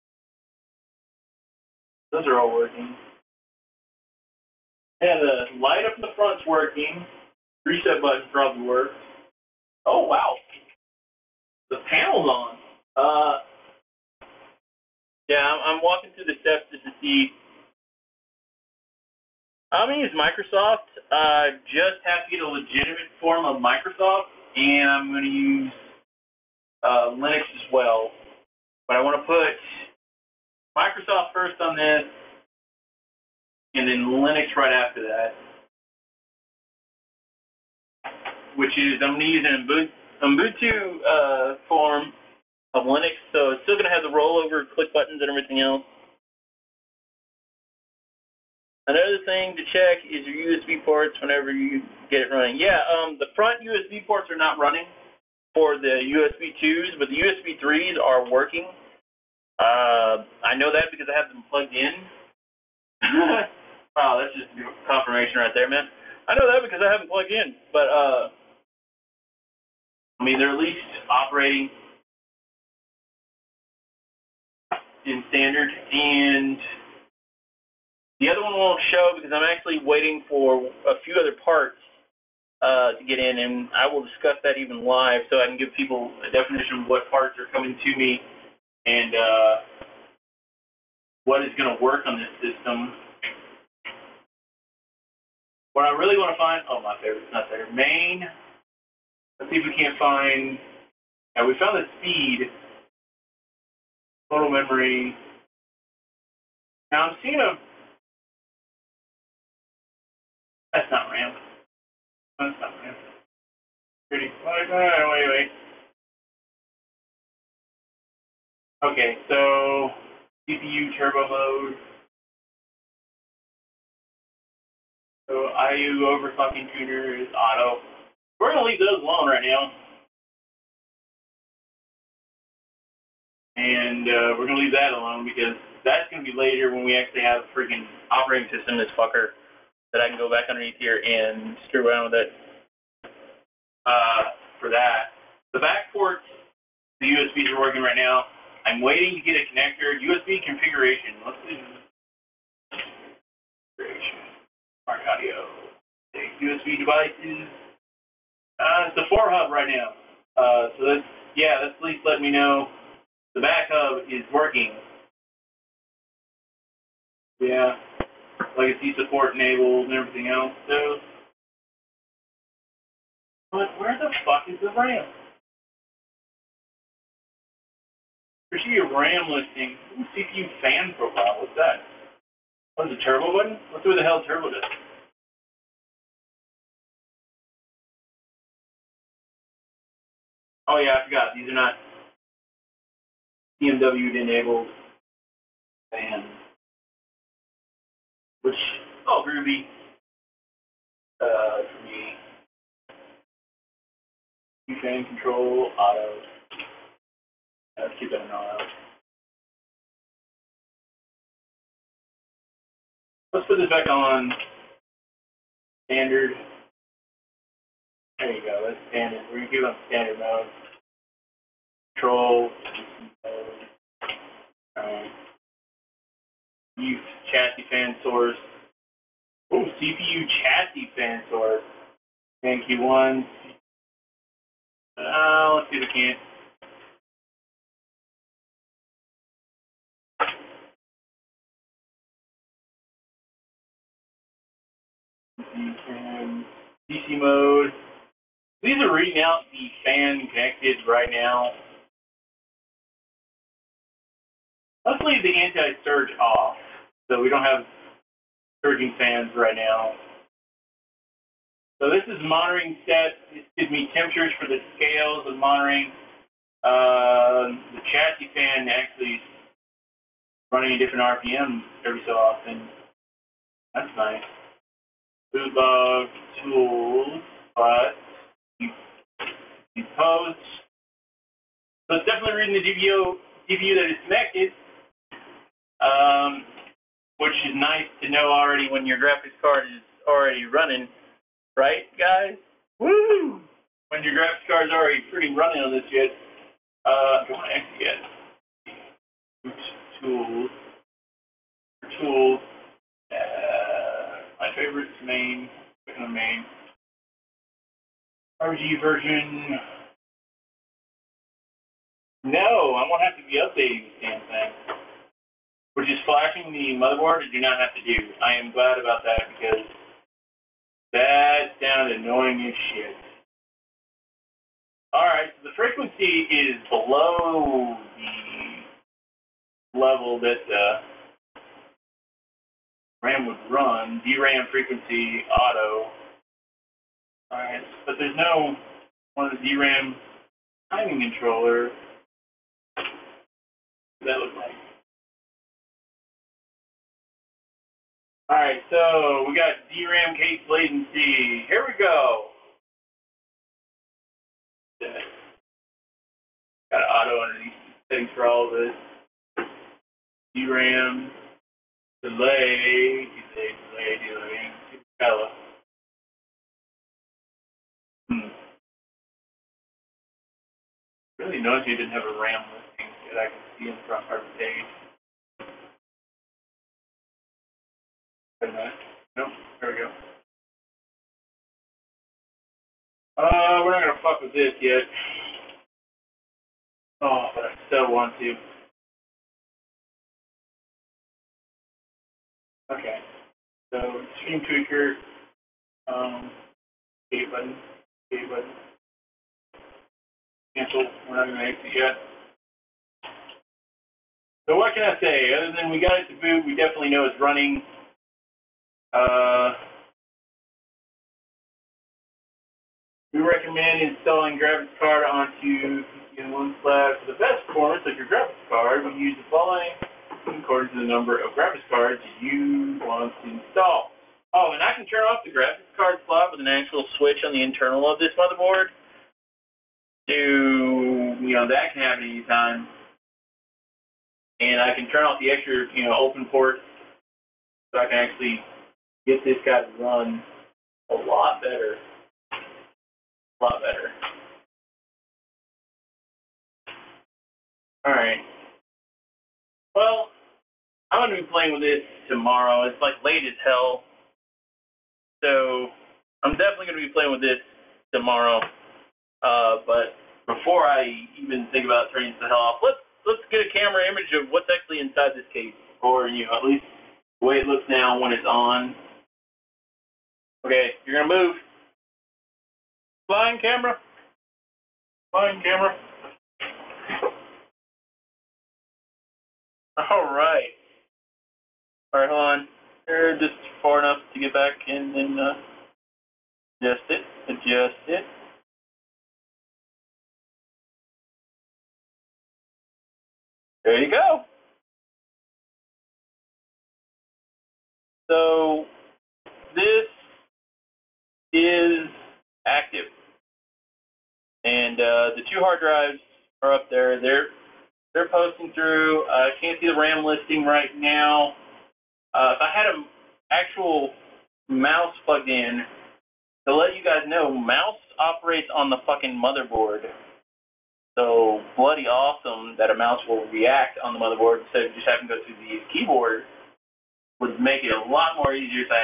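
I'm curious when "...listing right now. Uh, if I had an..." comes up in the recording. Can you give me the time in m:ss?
8:30.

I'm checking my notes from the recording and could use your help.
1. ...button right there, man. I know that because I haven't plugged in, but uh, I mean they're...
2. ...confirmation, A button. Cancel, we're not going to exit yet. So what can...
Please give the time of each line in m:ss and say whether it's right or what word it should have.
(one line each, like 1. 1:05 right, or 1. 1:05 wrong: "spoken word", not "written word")
1. 1:04 wrong: "confirmation", not "button"
2. 6:37 wrong: "button", not "confirmation".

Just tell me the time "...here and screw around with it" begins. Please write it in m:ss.
2:20.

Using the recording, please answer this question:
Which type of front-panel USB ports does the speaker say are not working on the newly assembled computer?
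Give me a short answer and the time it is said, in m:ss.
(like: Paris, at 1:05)
USB 2, at 0:56.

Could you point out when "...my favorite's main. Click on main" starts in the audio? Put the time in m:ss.
5:04.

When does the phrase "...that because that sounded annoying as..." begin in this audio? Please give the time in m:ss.
5:19.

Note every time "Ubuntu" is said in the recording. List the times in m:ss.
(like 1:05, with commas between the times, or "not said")
0:40.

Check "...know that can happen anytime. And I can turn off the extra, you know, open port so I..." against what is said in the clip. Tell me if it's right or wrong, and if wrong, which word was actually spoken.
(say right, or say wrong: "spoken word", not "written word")
right.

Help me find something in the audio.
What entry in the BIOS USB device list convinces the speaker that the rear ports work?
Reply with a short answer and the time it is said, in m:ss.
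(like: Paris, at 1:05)
four hub, at 2:38.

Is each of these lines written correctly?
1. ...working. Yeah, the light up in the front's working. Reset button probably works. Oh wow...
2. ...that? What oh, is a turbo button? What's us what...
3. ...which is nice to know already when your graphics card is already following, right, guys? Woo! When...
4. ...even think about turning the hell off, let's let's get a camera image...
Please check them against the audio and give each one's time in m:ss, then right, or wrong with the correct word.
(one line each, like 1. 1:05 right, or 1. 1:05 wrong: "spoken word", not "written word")
1. 0:02 right
2. 3:01 right
3. 4:47 wrong: "running", not "following"
4. 7:41 right.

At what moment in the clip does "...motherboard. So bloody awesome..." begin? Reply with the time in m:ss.
8:39.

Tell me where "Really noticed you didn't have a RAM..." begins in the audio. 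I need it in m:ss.
6:11.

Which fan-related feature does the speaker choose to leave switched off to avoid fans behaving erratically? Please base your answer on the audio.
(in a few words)
anti-surge.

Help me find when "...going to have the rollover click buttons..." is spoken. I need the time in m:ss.
0:43.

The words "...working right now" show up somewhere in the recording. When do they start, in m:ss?
2:27.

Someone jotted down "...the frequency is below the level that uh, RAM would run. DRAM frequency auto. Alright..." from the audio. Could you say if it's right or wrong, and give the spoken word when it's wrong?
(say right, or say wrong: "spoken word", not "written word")
right.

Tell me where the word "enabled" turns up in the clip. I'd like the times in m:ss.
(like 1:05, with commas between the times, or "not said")
2:49, 3:14.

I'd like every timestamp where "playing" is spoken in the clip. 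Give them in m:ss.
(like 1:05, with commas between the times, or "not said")
7:31, 7:36.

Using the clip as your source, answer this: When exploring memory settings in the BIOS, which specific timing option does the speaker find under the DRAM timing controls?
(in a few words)
DRAM CAS latency.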